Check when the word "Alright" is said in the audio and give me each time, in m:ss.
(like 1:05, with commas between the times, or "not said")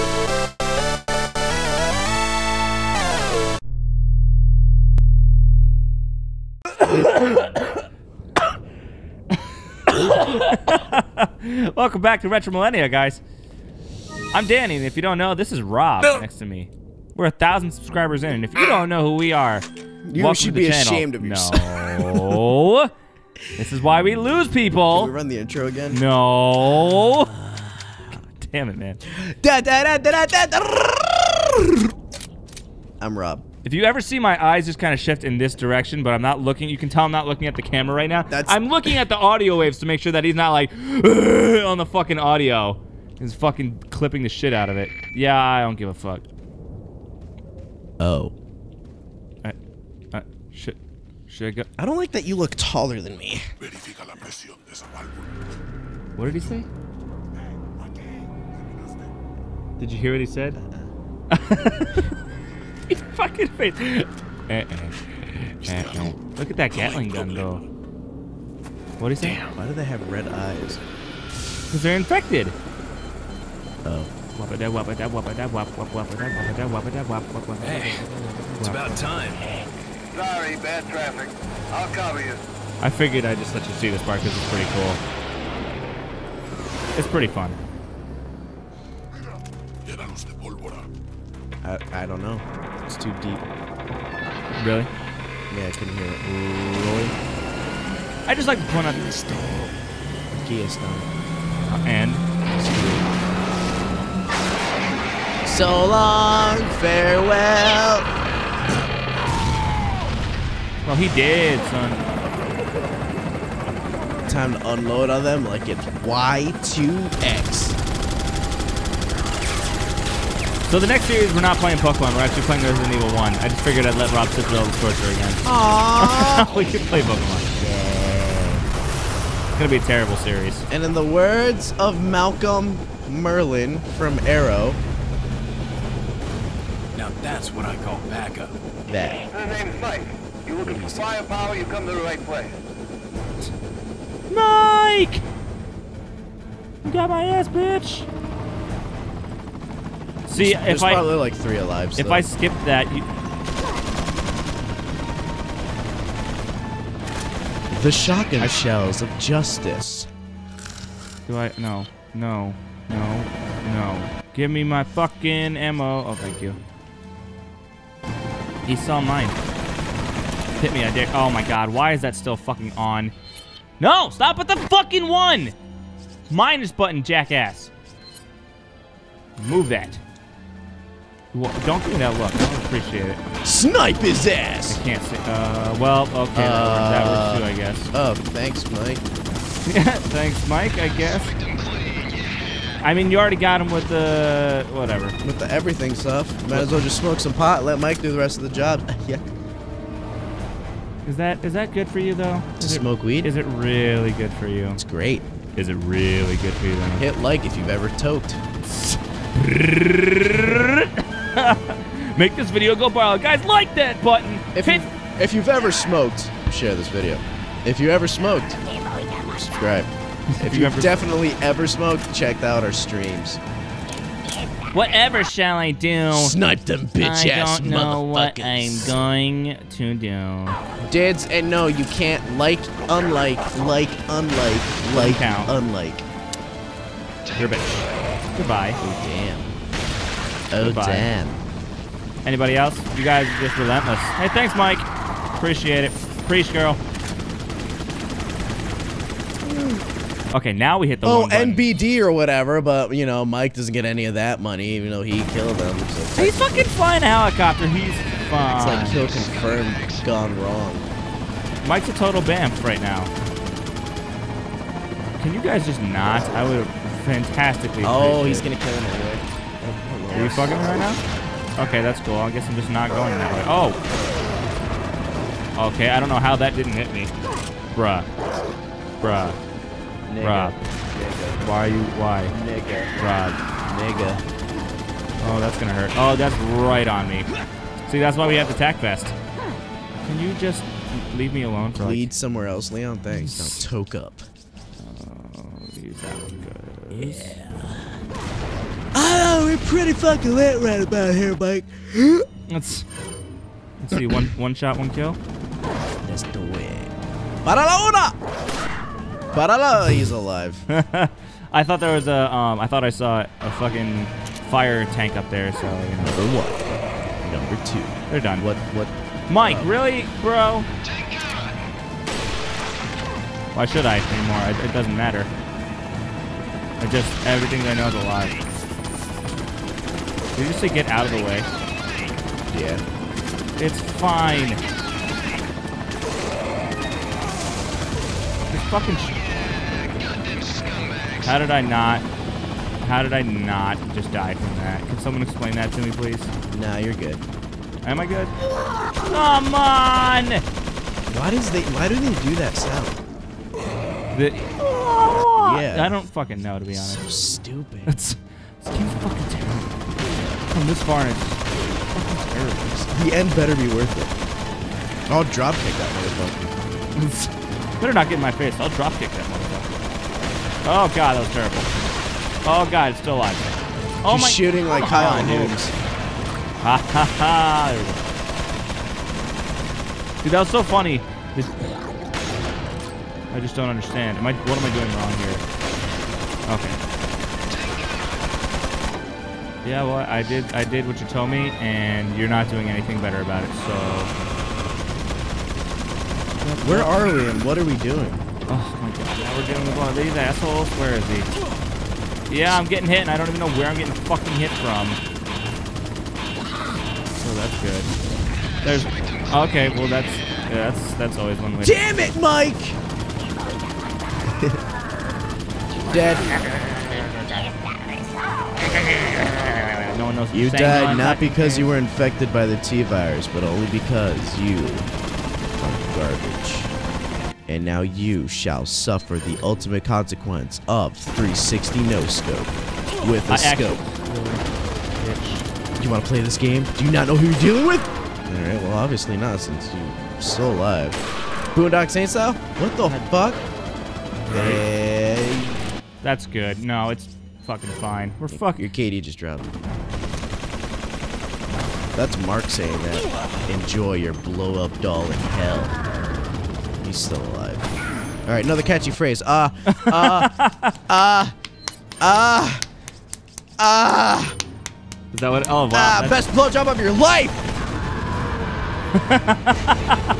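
7:38.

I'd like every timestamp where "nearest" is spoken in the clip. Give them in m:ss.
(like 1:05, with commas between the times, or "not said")
not said.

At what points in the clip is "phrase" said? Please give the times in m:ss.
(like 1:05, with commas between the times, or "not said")
7:38.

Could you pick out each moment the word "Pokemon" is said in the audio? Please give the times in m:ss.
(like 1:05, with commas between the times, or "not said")
2:01, 2:07.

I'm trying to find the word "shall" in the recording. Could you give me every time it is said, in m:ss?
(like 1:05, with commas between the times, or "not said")
3:45, 7:08.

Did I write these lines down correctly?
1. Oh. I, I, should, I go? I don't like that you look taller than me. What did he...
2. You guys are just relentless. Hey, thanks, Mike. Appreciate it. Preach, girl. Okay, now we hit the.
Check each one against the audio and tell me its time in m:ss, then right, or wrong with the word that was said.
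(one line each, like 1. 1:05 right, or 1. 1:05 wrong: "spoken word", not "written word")
1. 0:47 right
2. 4:02 right.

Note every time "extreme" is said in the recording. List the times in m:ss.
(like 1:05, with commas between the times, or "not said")
not said.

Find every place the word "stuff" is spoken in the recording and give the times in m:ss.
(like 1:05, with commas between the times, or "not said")
1:40, 3:15.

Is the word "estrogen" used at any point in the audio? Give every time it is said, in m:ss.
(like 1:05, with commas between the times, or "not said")
not said.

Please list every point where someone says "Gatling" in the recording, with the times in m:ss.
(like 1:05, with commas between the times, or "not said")
1:06.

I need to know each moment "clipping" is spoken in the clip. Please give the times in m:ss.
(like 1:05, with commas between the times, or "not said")
0:43.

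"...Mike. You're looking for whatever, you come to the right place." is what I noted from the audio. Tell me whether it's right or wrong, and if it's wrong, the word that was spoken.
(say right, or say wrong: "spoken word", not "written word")
wrong: "firepower", not "whatever".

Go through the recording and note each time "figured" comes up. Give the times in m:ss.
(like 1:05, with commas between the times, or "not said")
1:22, 2:03.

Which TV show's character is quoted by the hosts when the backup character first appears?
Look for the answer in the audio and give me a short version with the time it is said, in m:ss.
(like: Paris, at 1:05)
Arrow, at 2:14.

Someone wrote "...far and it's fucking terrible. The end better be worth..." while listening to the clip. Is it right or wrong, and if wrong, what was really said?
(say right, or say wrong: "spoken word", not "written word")
right.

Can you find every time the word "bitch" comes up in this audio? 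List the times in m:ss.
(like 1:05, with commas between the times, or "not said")
2:27, 3:46, 3:57.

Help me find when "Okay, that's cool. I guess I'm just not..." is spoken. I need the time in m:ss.
4:31.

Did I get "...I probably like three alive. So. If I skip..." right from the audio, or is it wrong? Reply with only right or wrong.
right.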